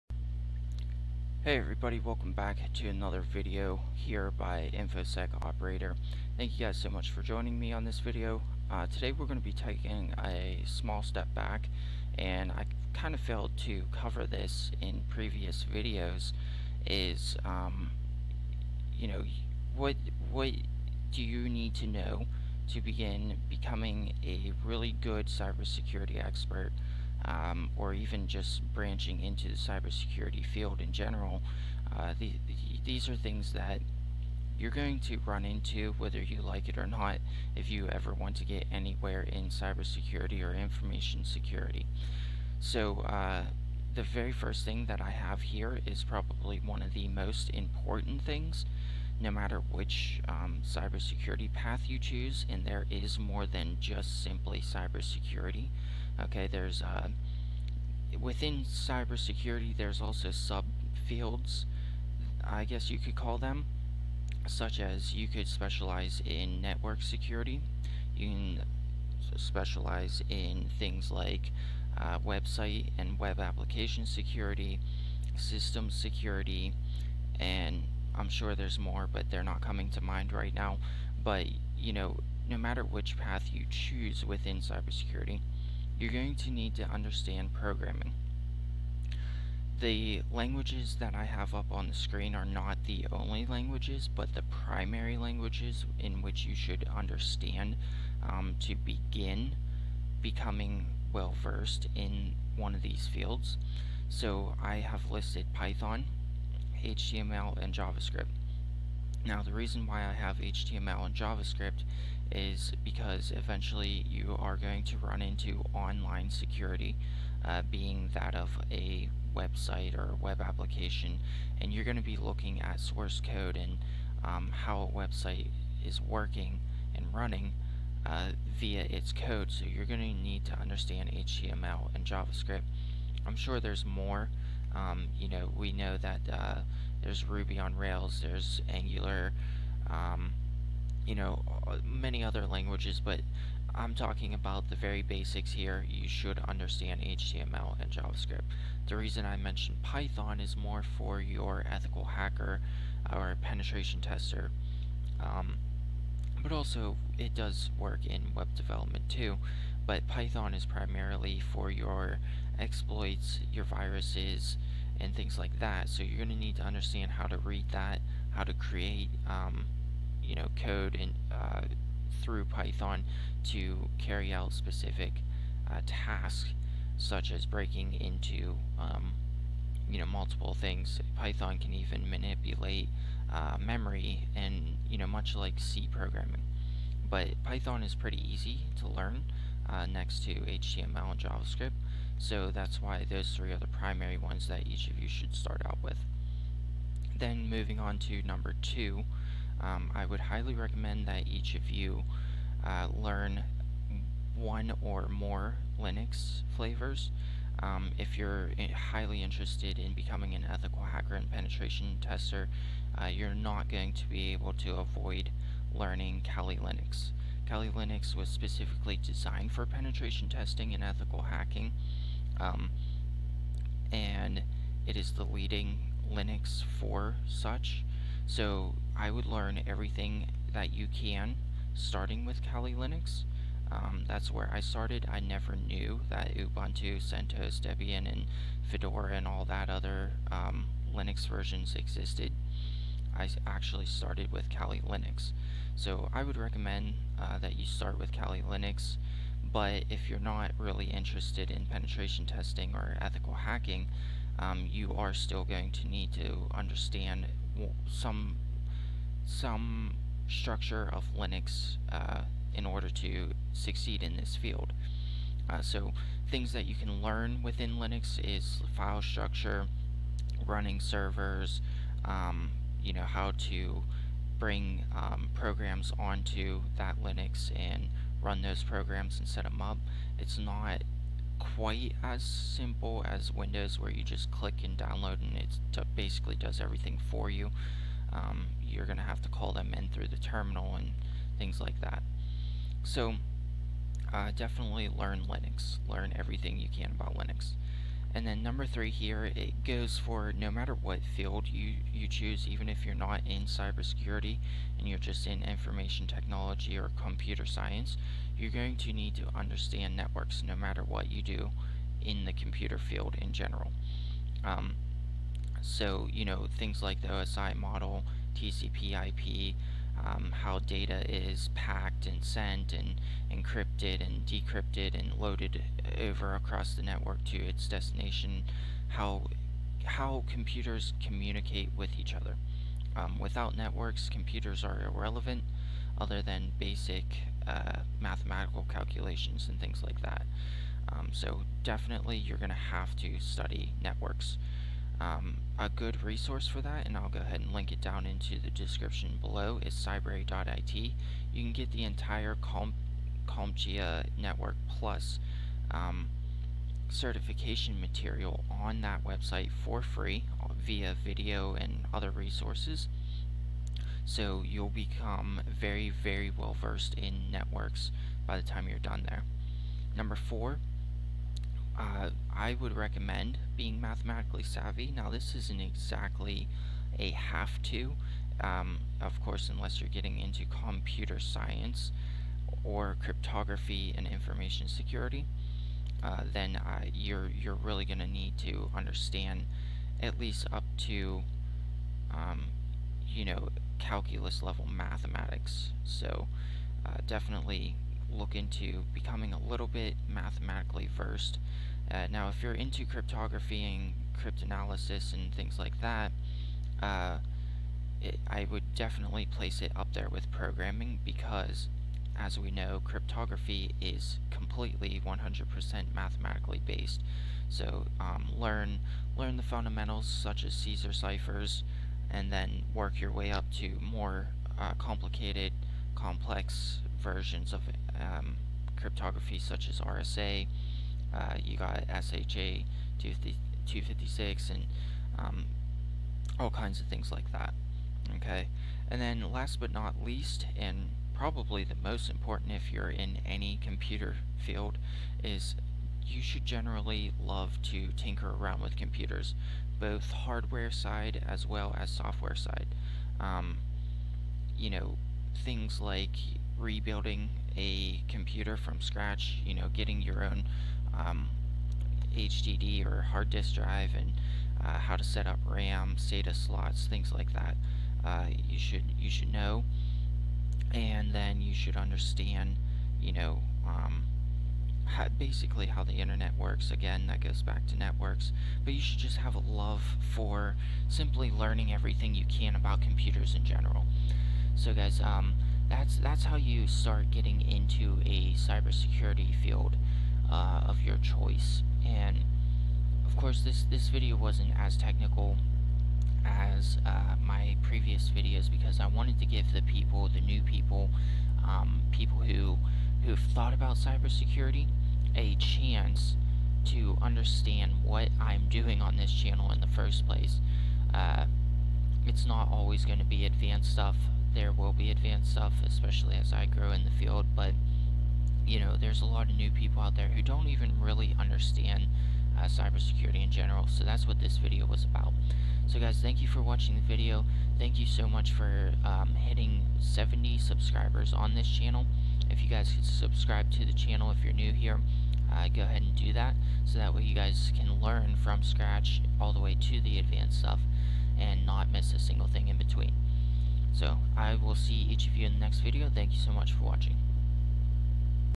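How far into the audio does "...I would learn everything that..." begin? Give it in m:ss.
3:48.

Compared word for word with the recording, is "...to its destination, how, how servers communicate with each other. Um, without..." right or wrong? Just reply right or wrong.
wrong.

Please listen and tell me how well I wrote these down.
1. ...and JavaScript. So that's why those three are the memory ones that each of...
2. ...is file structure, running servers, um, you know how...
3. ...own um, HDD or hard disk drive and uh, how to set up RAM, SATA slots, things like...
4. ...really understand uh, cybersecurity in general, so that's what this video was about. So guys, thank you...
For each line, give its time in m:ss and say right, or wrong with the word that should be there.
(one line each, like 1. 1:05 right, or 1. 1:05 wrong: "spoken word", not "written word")
1. 3:11 wrong: "primary", not "memory"
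2. 4:28 right
3. 7:40 right
4. 8:40 right.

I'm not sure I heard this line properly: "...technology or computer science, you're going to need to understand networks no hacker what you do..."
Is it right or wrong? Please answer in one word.
wrong.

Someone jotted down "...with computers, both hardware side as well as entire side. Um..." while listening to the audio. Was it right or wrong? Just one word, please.
wrong.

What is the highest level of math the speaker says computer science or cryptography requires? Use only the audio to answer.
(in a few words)
Calculus.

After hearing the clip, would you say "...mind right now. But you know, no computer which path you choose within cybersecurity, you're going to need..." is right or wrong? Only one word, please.
wrong.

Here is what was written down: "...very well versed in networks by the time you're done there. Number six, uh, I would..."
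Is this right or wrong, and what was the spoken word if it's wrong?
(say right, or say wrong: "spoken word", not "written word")
wrong: "four", not "six".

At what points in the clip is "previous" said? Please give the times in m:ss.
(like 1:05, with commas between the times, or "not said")
0:15, 8:17.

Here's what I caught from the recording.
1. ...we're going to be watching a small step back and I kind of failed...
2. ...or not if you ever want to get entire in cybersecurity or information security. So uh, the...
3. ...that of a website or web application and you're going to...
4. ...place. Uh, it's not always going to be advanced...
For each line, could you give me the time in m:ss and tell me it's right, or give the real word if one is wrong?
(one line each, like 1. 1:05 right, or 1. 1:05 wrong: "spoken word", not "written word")
1. 0:09 wrong: "taking", not "watching"
2. 0:36 wrong: "anywhere", not "entire"
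3. 1:58 right
4. 8:30 right.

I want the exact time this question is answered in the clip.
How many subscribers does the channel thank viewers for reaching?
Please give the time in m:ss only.
8:49.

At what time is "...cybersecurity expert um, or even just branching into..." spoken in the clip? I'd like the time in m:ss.
0:25.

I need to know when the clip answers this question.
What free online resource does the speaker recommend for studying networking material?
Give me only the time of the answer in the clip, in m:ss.
5:49.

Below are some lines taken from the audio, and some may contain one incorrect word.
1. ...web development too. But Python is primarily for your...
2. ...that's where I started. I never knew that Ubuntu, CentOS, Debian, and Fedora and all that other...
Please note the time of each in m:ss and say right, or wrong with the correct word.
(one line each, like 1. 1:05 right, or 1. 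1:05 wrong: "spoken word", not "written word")
1. 2:38 right
2. 3:54 right.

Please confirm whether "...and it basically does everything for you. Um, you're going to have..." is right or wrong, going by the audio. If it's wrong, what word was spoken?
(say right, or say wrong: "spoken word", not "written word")
right.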